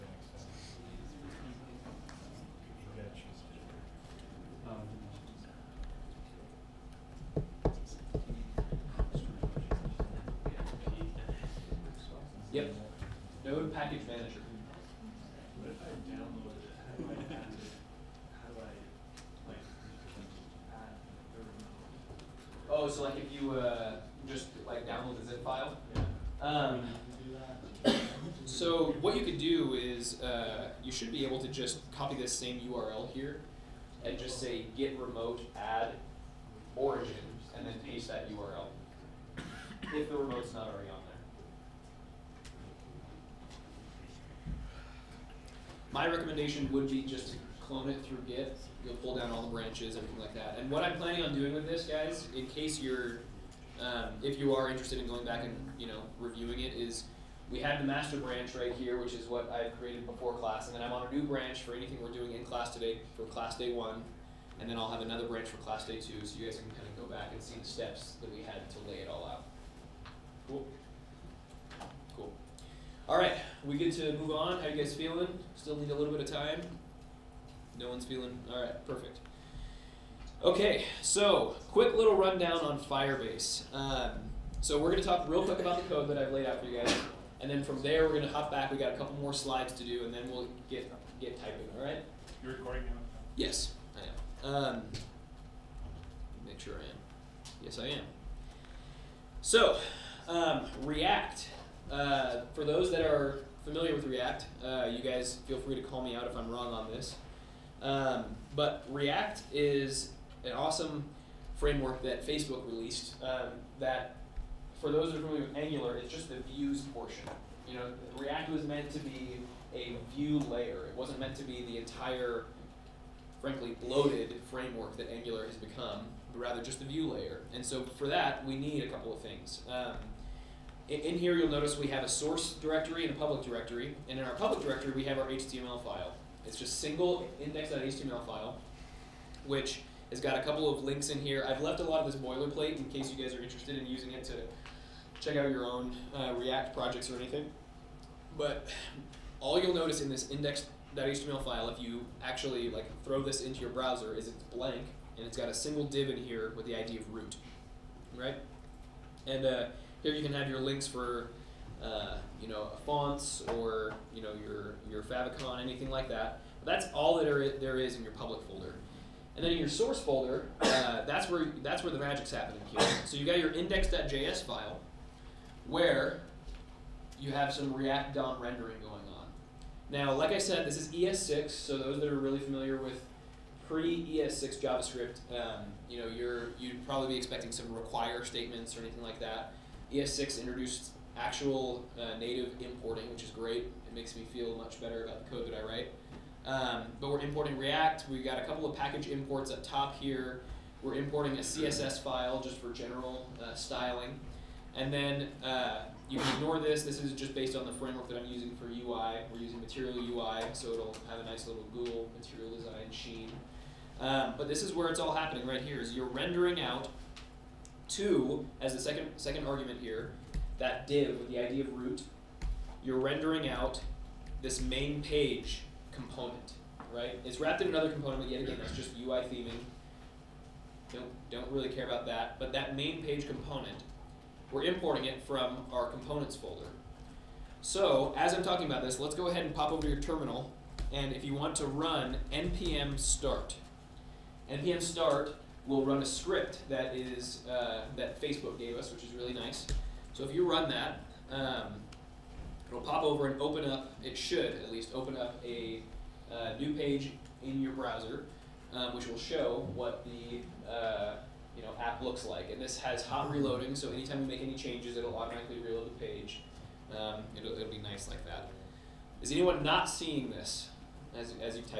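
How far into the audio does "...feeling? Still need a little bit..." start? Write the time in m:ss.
1:14.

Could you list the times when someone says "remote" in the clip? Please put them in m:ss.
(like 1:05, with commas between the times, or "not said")
0:34, 0:40.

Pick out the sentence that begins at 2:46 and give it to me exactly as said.
But that's all that are, there is in your public folder.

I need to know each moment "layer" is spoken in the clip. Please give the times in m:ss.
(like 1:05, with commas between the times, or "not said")
2:00, 2:07.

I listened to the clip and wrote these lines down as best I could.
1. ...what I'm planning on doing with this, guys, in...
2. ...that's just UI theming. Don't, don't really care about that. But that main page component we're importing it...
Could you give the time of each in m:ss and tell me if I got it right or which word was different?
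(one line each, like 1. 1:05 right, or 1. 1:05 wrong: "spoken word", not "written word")
1. 0:50 right
2. 3:48 right.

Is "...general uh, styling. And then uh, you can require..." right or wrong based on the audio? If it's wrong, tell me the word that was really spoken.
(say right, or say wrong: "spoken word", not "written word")
wrong: "ignore", not "require".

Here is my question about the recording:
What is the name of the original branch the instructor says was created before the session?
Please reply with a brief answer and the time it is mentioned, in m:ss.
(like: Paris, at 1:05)
master, at 0:57.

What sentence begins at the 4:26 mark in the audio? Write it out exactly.
Um, it'll, it'll be nice like that.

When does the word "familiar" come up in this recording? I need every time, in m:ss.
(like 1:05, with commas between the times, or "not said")
1:43, 1:55, 3:02.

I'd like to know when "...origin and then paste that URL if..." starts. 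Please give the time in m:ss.
0:36.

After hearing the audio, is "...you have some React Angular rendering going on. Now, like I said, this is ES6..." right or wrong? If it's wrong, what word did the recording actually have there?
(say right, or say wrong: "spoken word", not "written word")
wrong: "DOM", not "Angular".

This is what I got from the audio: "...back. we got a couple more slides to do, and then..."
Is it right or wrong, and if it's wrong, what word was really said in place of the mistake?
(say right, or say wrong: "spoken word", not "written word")
right.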